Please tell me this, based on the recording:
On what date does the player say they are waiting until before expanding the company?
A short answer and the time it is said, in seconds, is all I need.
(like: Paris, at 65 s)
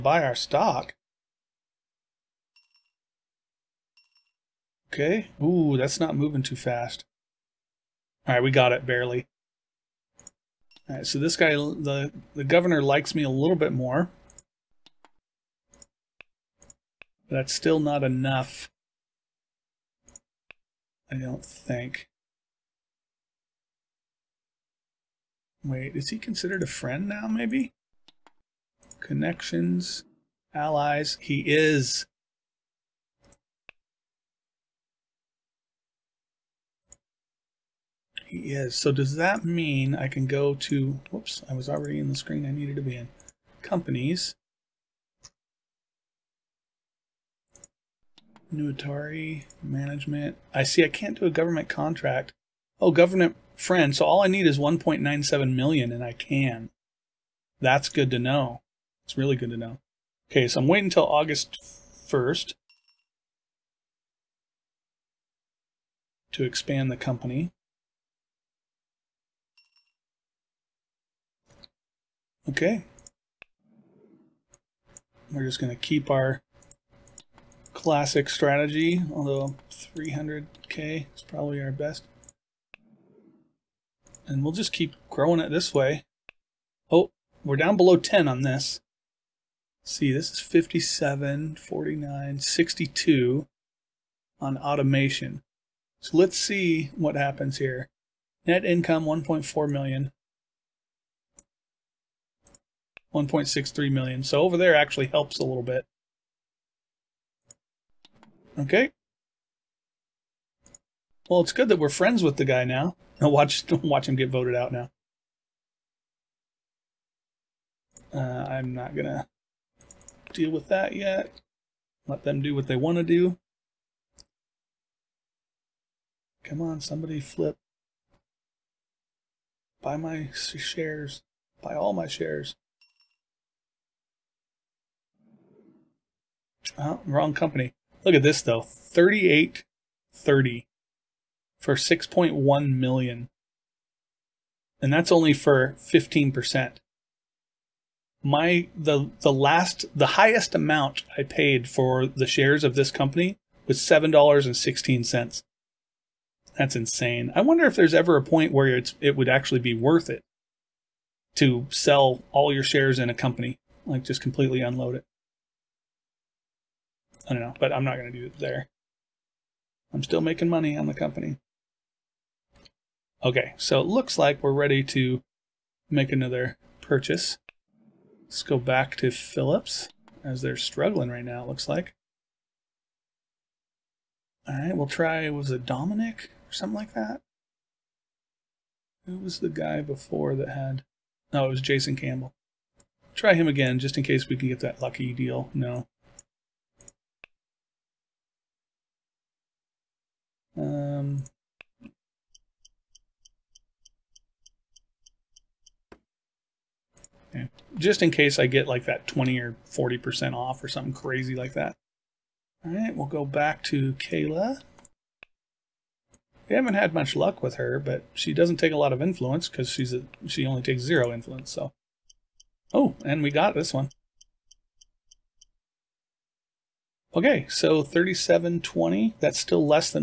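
August 1st, at 61 s.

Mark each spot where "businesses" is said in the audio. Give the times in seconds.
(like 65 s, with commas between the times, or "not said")
not said.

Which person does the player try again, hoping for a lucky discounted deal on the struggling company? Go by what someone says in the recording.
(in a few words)
Jason Campbell.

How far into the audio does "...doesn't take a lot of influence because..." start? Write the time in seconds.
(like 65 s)
218 s.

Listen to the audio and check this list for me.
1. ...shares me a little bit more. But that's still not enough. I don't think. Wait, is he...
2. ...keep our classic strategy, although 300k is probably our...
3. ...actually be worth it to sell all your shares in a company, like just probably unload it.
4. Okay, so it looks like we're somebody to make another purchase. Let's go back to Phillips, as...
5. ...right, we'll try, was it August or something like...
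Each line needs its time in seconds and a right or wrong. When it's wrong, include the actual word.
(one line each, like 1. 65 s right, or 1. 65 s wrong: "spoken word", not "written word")
1. 12 s wrong: "likes", not "shares"
2. 75 s right
3. 159 s wrong: "completely", not "probably"
4. 173 s wrong: "ready", not "somebody"
5. 184 s wrong: "Dominic", not "August".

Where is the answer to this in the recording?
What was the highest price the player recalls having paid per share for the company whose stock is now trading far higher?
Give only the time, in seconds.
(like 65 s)
153 s.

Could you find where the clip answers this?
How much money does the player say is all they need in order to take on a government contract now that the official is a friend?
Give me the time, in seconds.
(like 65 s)
54 s.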